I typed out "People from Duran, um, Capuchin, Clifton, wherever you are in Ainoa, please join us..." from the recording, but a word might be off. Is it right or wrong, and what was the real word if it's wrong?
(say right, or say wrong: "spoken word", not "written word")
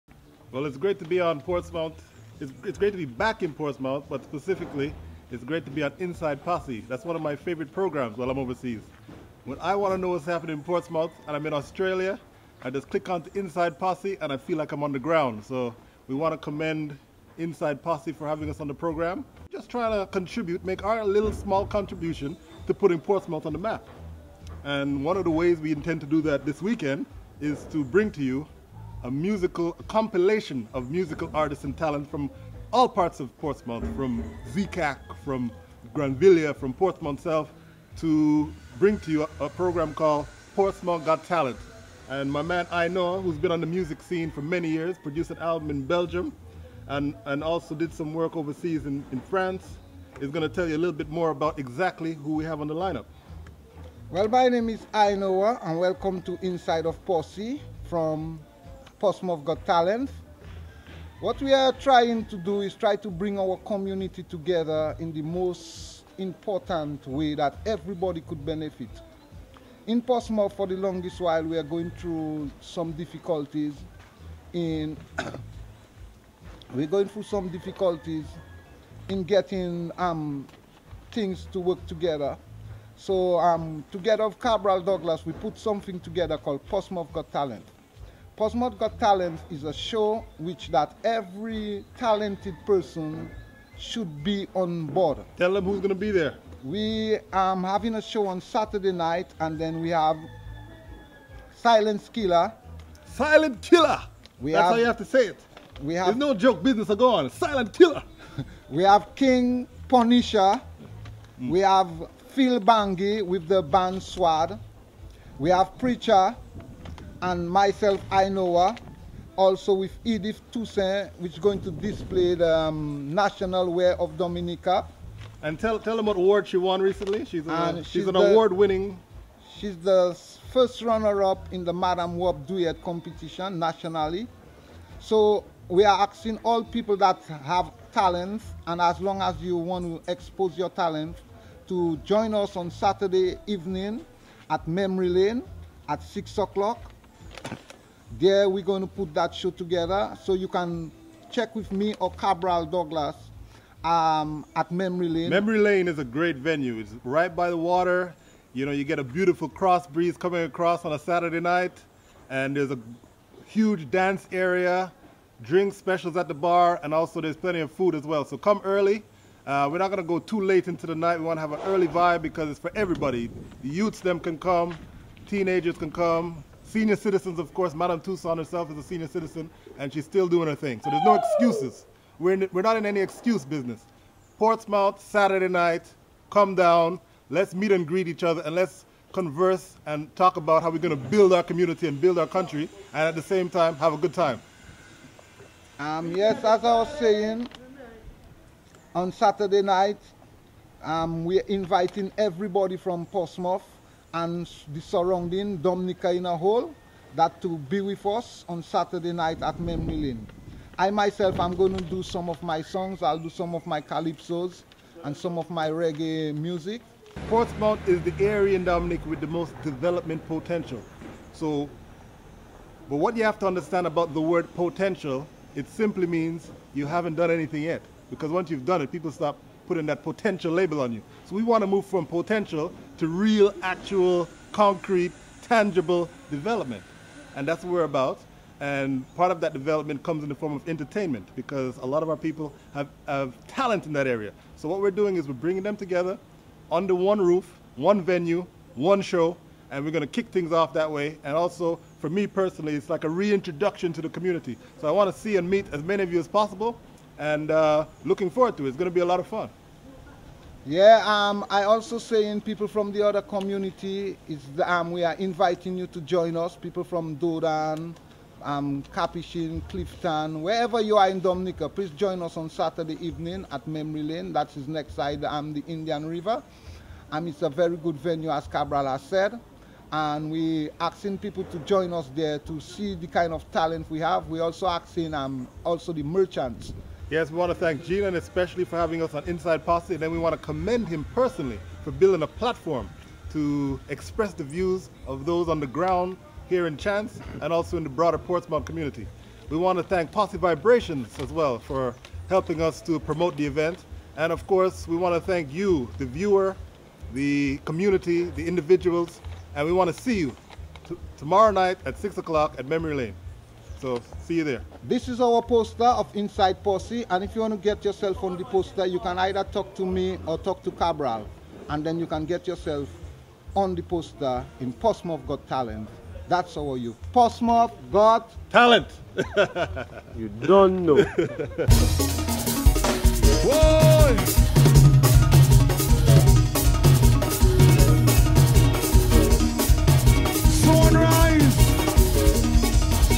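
wrong: "Dominica", not "Ainoa".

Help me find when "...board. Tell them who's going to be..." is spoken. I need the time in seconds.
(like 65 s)
94 s.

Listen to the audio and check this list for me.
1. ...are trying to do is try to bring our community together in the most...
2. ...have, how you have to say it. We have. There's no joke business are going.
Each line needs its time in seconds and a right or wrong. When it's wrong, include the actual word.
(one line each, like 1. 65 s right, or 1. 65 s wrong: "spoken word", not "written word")
1. 61 s right
2. 104 s right.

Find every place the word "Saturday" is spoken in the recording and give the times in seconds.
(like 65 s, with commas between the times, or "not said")
98 s, 142 s, 160 s, 185 s, 199 s, 208 s, 272 s.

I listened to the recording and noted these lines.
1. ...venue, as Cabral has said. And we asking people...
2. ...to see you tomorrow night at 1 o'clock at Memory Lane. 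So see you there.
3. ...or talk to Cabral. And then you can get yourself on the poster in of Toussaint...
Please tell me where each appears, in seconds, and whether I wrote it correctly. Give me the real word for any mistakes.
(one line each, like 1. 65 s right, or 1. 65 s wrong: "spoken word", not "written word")
1. 277 s right
2. 309 s wrong: "6", not "1"
3. 320 s wrong: "Got", not "Toussaint".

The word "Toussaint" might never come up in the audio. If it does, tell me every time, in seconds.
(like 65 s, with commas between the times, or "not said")
120 s, 177 s.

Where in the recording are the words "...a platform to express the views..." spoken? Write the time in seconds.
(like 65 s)
292 s.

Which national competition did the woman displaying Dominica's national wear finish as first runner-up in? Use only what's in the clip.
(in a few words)
Madame Wob Dwiyet.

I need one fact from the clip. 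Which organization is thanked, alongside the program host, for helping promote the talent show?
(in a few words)
Posse Vibrations.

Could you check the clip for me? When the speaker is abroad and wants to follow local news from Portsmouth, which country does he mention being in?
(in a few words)
Australia.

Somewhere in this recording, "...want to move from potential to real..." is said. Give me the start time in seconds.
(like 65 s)
231 s.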